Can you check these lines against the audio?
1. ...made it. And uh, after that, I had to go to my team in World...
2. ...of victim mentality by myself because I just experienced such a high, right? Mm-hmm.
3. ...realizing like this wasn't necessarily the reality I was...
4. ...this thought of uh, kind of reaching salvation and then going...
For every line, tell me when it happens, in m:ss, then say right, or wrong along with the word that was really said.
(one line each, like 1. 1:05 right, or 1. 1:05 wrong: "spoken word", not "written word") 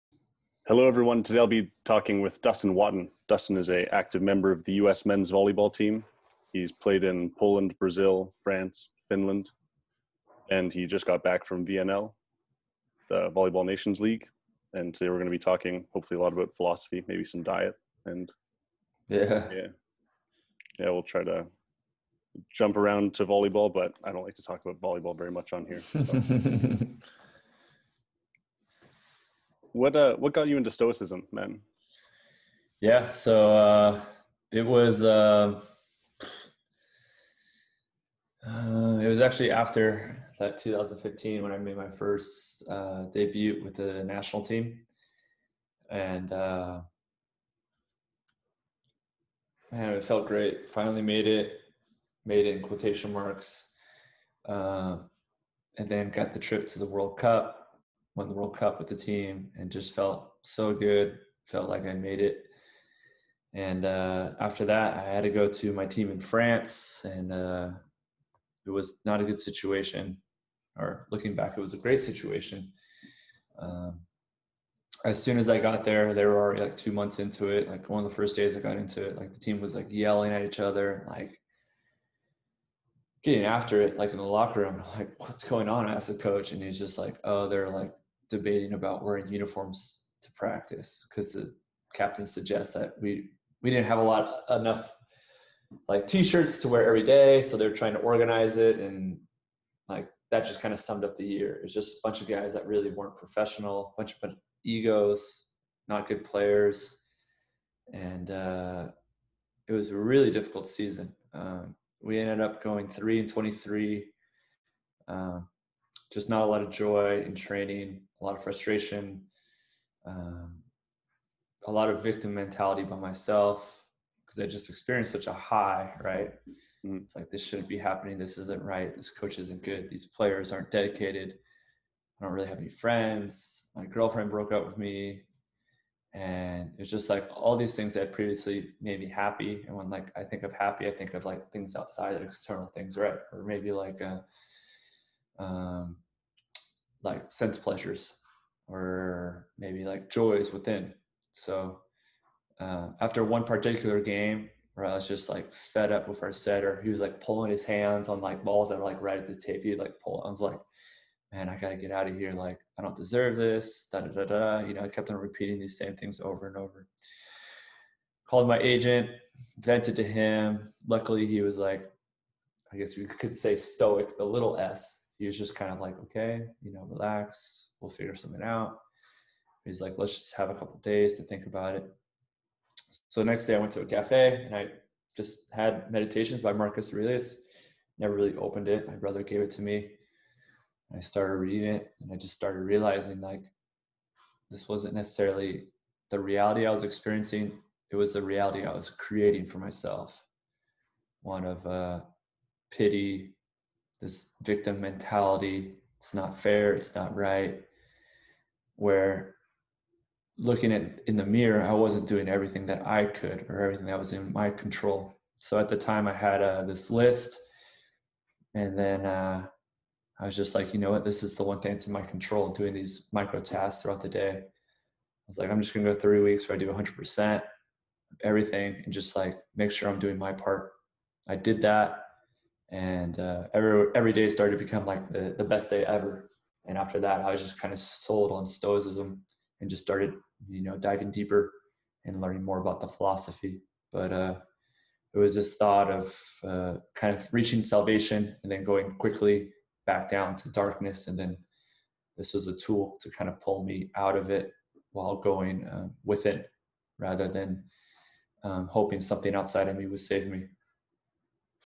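1. 1:01 wrong: "France", not "World"
2. 2:01 right
3. 3:12 right
4. 4:05 right.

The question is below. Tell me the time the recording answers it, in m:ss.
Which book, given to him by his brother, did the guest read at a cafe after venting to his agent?
3:05.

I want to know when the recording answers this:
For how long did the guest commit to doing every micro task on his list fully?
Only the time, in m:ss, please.
3:45.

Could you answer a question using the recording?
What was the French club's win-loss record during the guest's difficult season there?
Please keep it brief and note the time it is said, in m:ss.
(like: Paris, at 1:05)
3 and 23, at 1:52.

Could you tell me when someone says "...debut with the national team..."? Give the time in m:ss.
0:43.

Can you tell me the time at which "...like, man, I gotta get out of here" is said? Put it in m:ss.
2:40.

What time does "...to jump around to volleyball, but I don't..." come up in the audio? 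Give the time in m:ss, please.
0:21.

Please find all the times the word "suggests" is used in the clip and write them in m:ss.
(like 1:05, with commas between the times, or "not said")
1:32.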